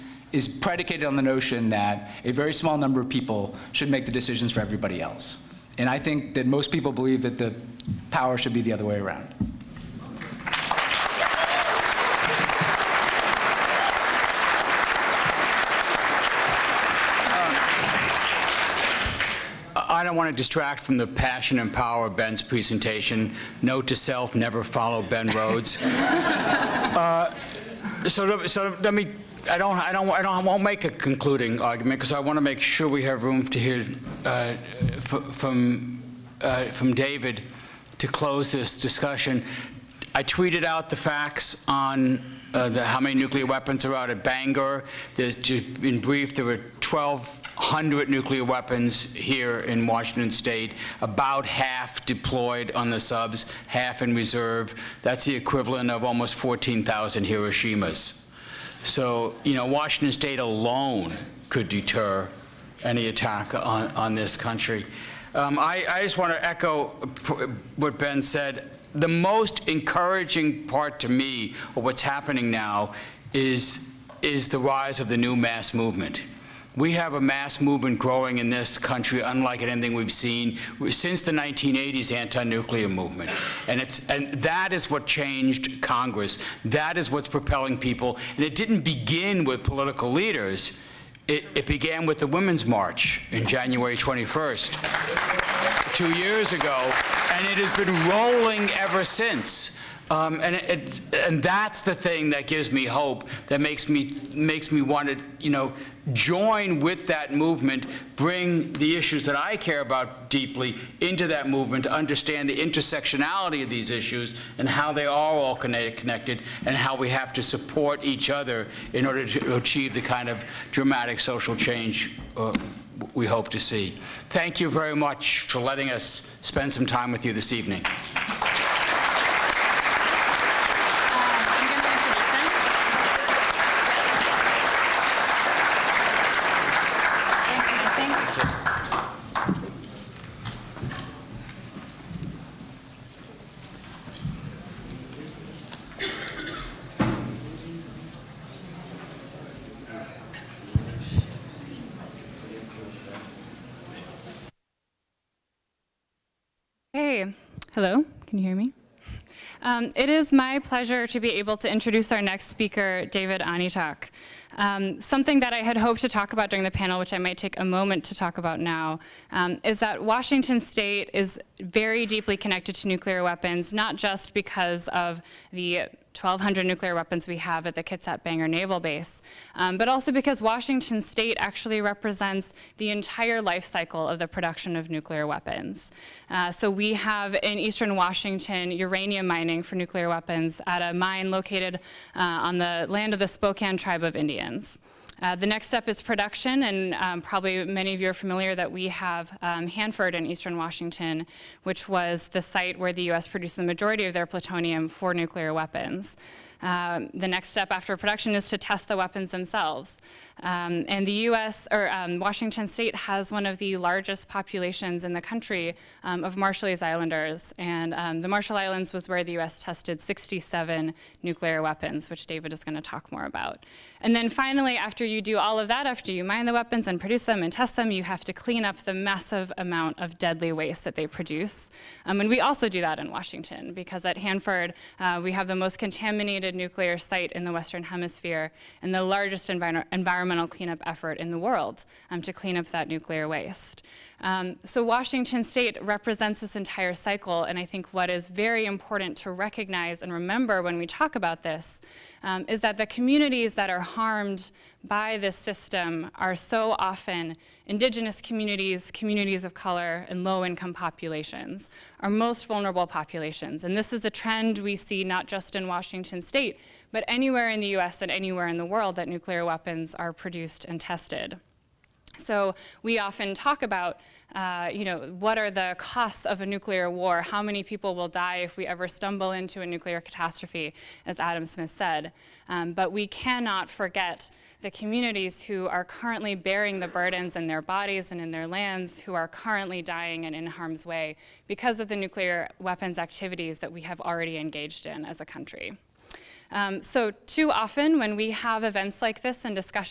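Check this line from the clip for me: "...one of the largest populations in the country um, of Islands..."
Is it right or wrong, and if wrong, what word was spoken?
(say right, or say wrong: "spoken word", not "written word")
wrong: "Marshallese", not "Islands".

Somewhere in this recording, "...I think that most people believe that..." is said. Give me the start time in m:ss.
0:05.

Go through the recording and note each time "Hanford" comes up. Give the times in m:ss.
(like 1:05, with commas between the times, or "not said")
3:19, 3:54.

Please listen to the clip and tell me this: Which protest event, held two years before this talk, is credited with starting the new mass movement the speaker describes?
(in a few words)
Women's March.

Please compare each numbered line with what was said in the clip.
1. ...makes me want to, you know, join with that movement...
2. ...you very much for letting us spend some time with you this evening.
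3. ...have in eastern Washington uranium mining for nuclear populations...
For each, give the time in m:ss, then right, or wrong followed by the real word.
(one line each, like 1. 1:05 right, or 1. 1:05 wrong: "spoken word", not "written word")
1. 1:44 right
2. 2:04 right
3. 3:06 wrong: "weapons", not "populations".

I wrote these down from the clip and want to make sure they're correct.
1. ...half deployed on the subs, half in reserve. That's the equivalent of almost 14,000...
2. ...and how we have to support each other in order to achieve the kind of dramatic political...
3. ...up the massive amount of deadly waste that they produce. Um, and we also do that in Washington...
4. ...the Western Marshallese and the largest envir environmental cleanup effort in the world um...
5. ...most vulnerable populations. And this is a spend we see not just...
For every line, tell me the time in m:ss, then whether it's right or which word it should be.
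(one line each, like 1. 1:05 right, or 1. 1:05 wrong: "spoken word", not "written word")
1. 0:51 right
2. 1:56 wrong: "social", not "political"
3. 3:48 right
4. 3:57 wrong: "Hemisphere", not "Marshallese"
5. 4:22 wrong: "trend", not "spend".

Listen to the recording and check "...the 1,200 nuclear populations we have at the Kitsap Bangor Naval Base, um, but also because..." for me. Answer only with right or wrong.
wrong.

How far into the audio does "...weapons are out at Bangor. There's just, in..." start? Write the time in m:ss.
0:43.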